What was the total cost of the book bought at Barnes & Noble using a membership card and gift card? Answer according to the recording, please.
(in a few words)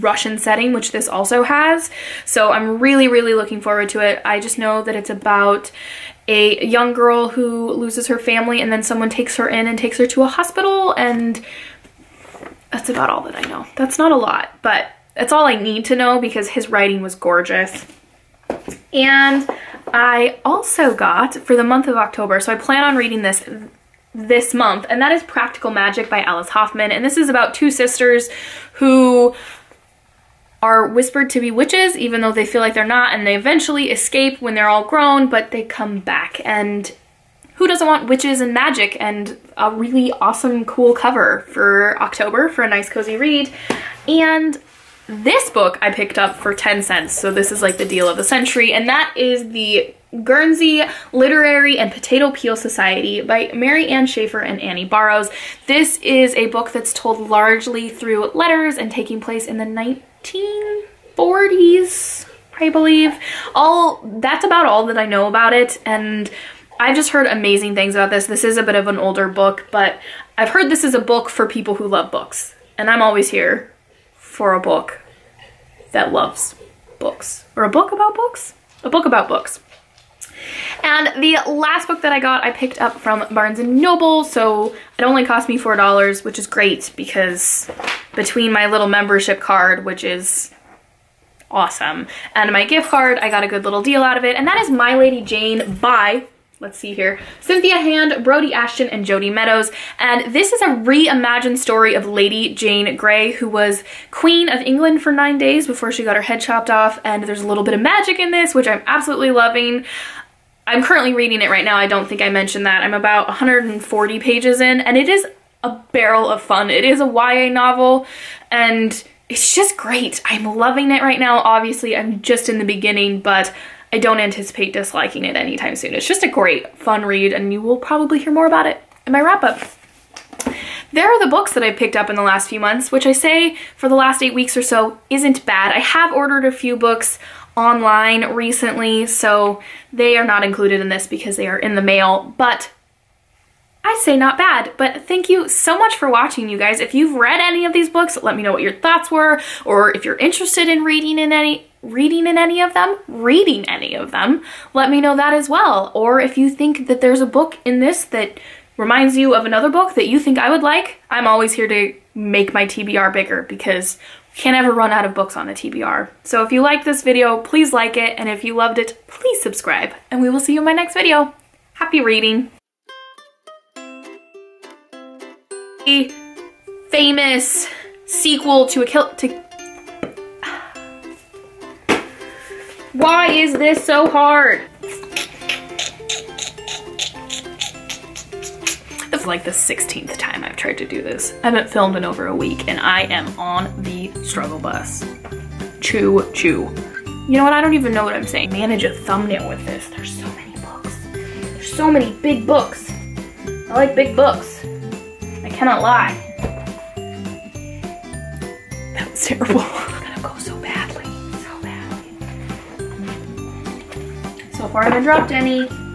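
$4.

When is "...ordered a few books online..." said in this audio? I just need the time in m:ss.
2:16.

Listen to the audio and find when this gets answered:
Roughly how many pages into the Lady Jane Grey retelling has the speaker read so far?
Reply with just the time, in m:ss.
1:53.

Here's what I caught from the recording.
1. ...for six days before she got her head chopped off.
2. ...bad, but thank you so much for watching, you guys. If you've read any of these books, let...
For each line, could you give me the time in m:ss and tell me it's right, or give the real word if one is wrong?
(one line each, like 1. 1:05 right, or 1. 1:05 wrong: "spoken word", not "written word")
1. 1:45 wrong: "nine", not "six"
2. 2:24 right.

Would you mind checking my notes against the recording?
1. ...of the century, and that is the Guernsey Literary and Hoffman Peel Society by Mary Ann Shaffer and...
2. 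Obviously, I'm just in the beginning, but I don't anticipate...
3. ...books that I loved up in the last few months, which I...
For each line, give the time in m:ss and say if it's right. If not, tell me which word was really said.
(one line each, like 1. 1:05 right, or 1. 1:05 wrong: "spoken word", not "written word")
1. 0:48 wrong: "Potato", not "Hoffman"
2. 2:01 right
3. 2:11 wrong: "picked", not "loved".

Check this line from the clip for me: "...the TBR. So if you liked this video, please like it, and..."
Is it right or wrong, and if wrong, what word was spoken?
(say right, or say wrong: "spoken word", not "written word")
right.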